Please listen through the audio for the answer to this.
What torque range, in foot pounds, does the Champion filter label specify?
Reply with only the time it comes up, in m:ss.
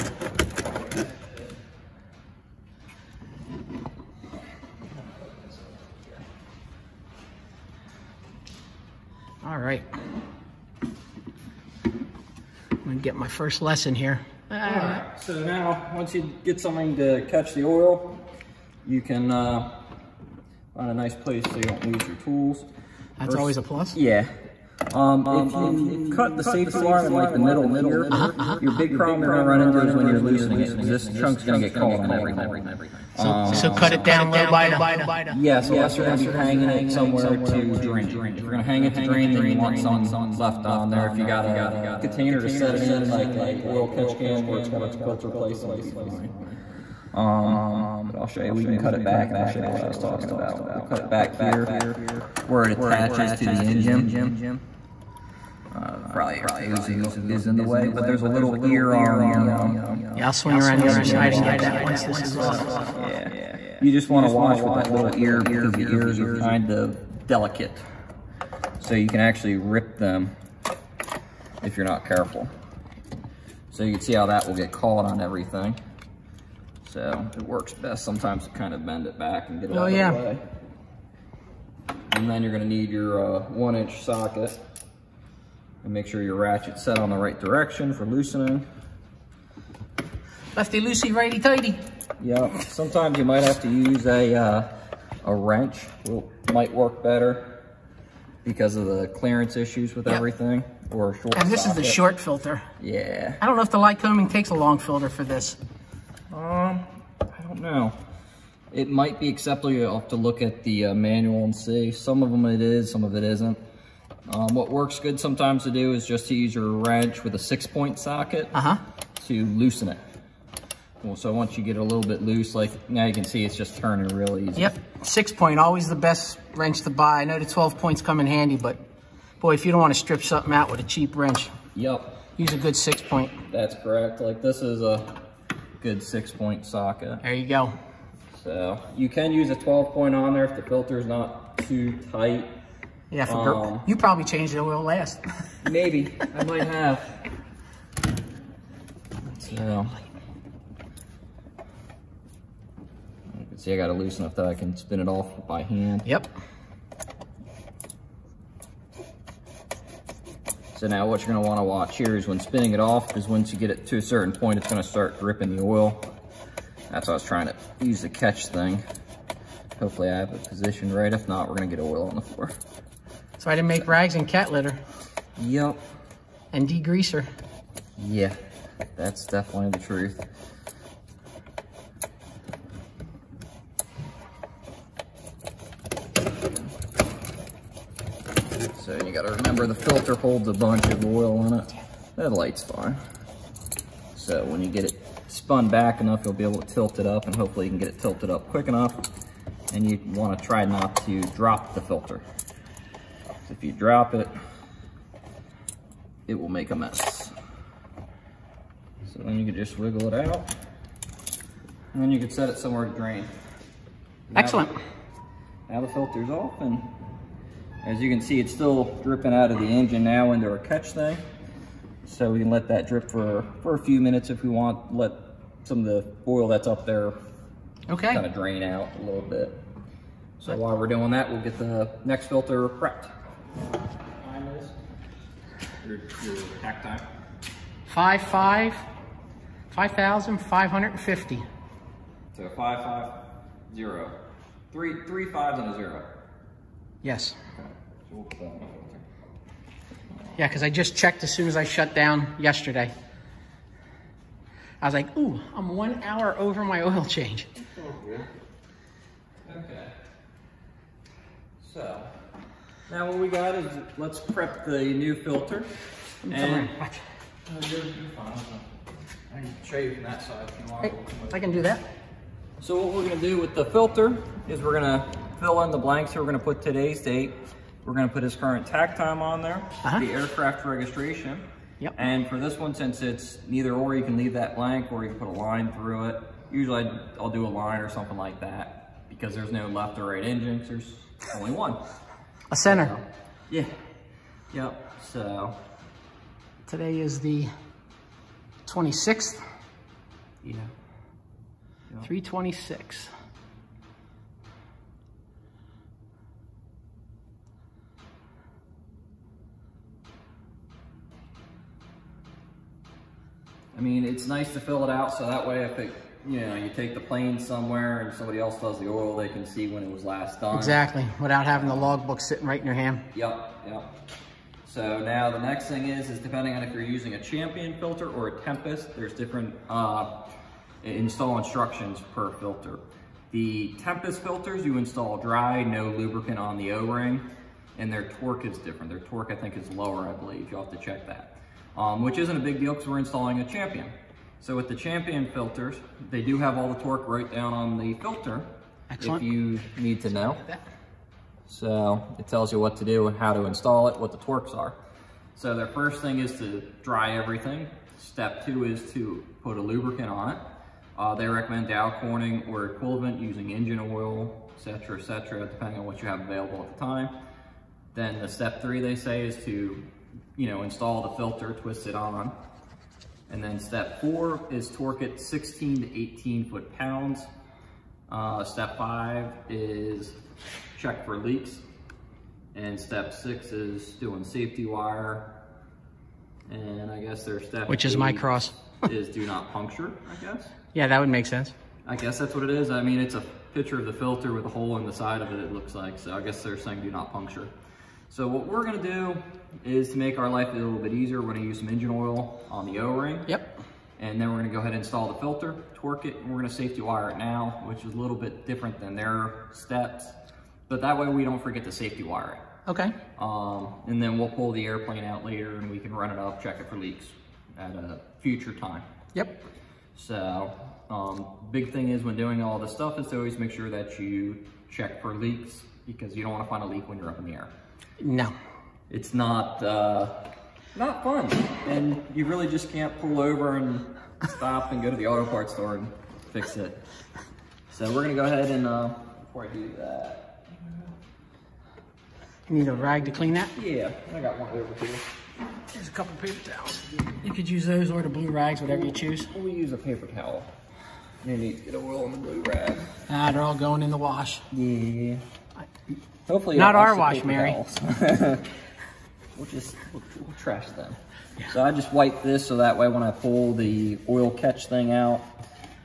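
6:15.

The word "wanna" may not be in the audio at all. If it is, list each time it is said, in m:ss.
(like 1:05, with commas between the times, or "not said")
1:04, 2:41, 3:20.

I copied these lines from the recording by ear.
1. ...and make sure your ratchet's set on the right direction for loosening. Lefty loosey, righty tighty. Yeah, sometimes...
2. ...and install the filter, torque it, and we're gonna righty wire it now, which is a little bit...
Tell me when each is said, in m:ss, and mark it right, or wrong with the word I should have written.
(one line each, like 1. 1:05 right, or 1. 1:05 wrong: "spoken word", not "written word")
1. 1:25 right
2. 6:44 wrong: "safety", not "righty".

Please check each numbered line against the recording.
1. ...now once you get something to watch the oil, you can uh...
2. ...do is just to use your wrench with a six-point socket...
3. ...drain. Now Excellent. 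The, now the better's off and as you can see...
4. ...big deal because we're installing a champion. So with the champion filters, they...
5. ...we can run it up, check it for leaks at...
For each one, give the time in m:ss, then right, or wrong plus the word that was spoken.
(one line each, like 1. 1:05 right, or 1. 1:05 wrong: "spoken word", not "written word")
1. 0:15 wrong: "catch", not "watch"
2. 1:55 right
3. 3:32 wrong: "filter", not "better"
4. 5:42 right
5. 6:55 right.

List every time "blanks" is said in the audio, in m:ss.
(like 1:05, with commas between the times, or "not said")
4:35, 4:44.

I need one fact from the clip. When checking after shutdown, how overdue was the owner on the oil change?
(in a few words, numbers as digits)
1 hour.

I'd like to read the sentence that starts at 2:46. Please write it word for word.
That's why I was trying to use the catch thing.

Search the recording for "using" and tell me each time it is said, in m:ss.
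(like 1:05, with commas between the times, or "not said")
5:26, 6:03.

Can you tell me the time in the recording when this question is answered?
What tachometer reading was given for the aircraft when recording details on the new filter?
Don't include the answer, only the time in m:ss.
3:59.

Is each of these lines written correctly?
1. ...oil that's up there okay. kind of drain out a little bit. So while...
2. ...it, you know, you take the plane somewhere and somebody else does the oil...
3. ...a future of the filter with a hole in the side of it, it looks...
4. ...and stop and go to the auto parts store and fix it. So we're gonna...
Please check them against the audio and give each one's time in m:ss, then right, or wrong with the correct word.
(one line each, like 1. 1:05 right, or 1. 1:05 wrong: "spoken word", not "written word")
1. 3:46 right
2. 5:15 right
3. 6:33 wrong: "picture", not "future"
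4. 7:13 right.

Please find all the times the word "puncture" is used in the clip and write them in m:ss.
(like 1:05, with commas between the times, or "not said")
6:29, 6:37.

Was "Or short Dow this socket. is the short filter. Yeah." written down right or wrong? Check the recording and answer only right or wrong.
wrong.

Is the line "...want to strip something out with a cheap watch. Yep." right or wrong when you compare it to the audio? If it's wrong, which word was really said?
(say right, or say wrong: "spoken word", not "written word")
wrong: "wrench", not "watch".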